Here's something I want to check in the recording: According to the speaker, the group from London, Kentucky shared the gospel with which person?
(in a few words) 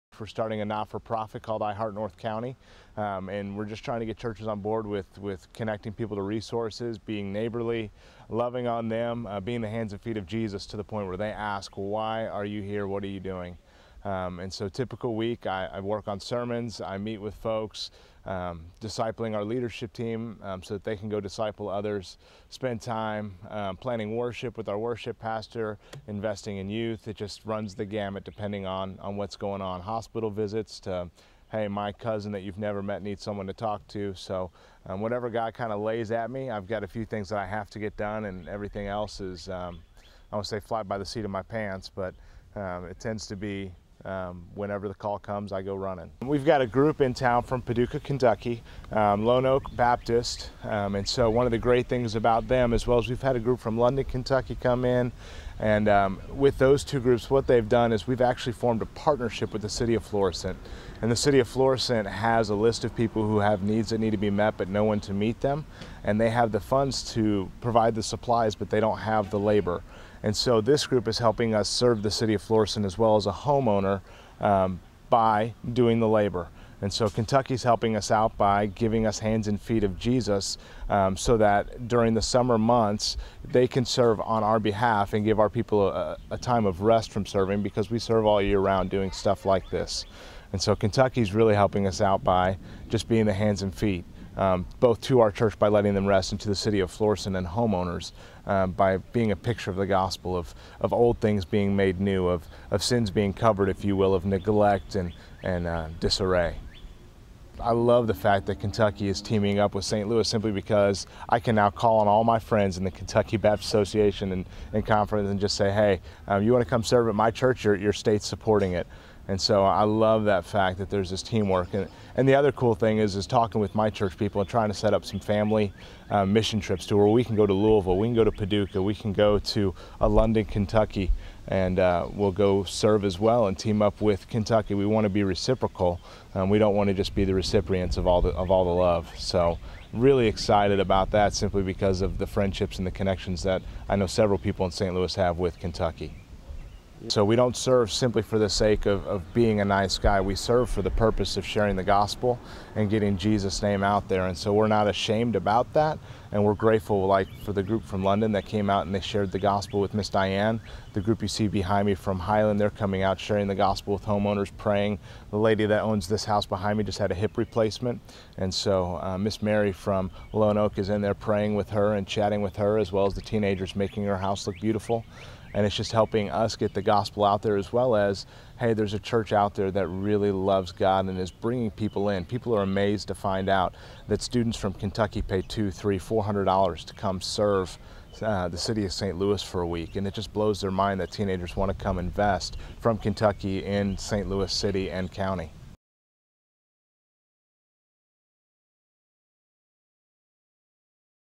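Miss Diane.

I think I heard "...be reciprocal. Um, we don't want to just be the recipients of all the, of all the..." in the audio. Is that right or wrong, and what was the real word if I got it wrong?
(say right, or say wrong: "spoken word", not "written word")
right.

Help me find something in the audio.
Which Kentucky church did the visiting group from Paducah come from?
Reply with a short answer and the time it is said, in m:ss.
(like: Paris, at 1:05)
Lone Oak Baptist, at 0:49.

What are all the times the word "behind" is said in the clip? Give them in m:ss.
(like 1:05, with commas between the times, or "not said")
2:41, 2:46.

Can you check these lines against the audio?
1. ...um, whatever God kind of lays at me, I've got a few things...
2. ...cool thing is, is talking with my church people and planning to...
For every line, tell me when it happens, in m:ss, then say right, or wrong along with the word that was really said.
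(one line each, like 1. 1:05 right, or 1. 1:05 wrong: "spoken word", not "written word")
1. 0:34 right
2. 2:02 wrong: "trying", not "planning".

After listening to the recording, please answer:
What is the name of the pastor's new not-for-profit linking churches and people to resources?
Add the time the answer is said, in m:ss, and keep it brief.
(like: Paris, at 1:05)
I Heart North County, at 0:01.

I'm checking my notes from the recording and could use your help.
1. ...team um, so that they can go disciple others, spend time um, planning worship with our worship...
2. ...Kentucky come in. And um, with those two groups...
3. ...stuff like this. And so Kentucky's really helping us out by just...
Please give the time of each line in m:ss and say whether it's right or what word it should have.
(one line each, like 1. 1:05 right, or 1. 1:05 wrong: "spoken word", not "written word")
1. 0:19 right
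2. 0:54 right
3. 1:29 right.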